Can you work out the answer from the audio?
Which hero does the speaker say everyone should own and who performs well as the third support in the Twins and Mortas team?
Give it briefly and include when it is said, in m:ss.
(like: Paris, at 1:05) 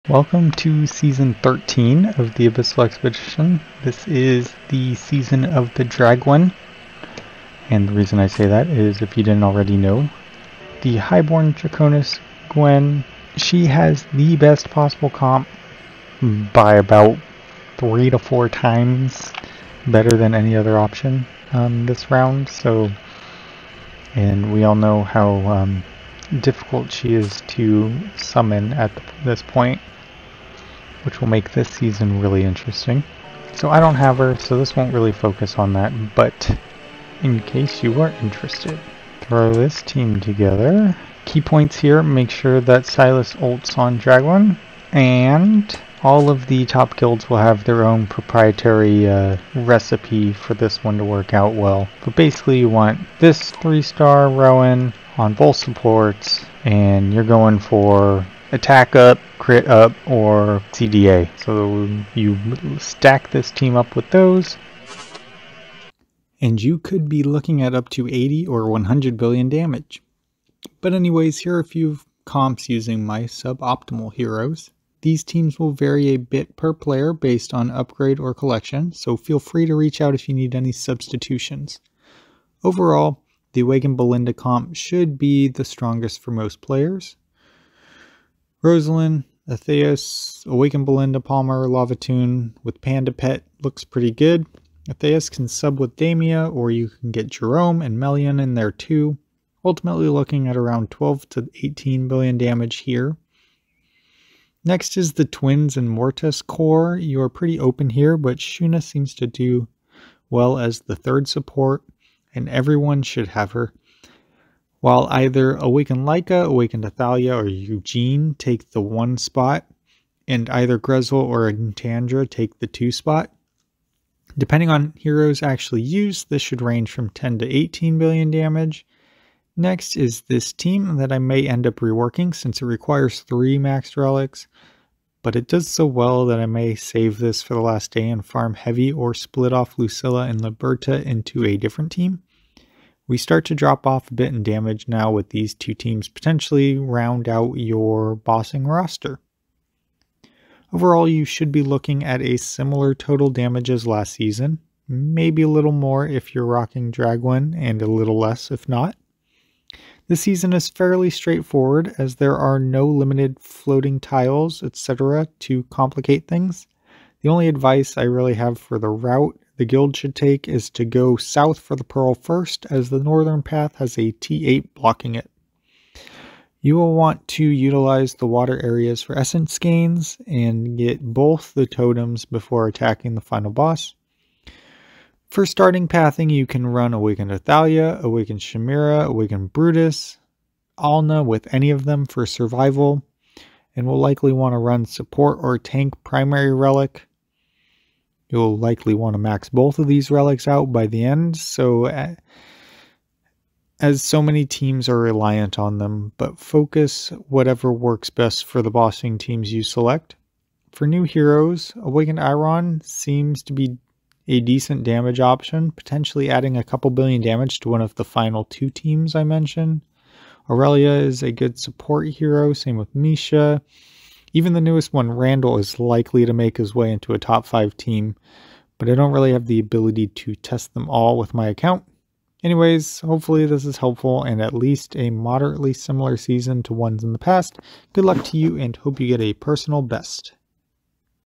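Shuna, at 1:48.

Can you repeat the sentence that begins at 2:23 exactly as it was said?
We start to drop off a bit in damage now with these two teams potentially round out your bossing roster.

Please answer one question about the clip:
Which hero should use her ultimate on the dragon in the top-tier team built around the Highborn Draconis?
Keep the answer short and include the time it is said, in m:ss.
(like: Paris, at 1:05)
Silas, at 0:42.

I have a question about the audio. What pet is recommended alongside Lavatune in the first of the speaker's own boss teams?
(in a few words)
Panda.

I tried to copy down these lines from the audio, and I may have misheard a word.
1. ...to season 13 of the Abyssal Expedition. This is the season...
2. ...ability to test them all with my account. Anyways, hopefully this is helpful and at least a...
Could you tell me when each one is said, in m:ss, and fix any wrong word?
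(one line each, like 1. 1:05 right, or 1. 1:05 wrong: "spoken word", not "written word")
1. 0:00 right
2. 3:49 right.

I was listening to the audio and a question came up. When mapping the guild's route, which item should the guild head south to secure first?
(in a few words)
The Pearl.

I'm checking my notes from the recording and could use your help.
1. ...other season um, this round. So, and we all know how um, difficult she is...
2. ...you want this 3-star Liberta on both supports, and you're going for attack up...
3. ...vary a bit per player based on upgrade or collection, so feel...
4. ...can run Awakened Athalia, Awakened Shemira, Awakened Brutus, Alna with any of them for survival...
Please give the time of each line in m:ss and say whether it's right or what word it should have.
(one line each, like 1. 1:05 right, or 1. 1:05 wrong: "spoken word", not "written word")
1. 0:20 wrong: "option", not "season"
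2. 0:52 wrong: "Rowan", not "Liberta"
3. 1:15 right
4. 3:06 right.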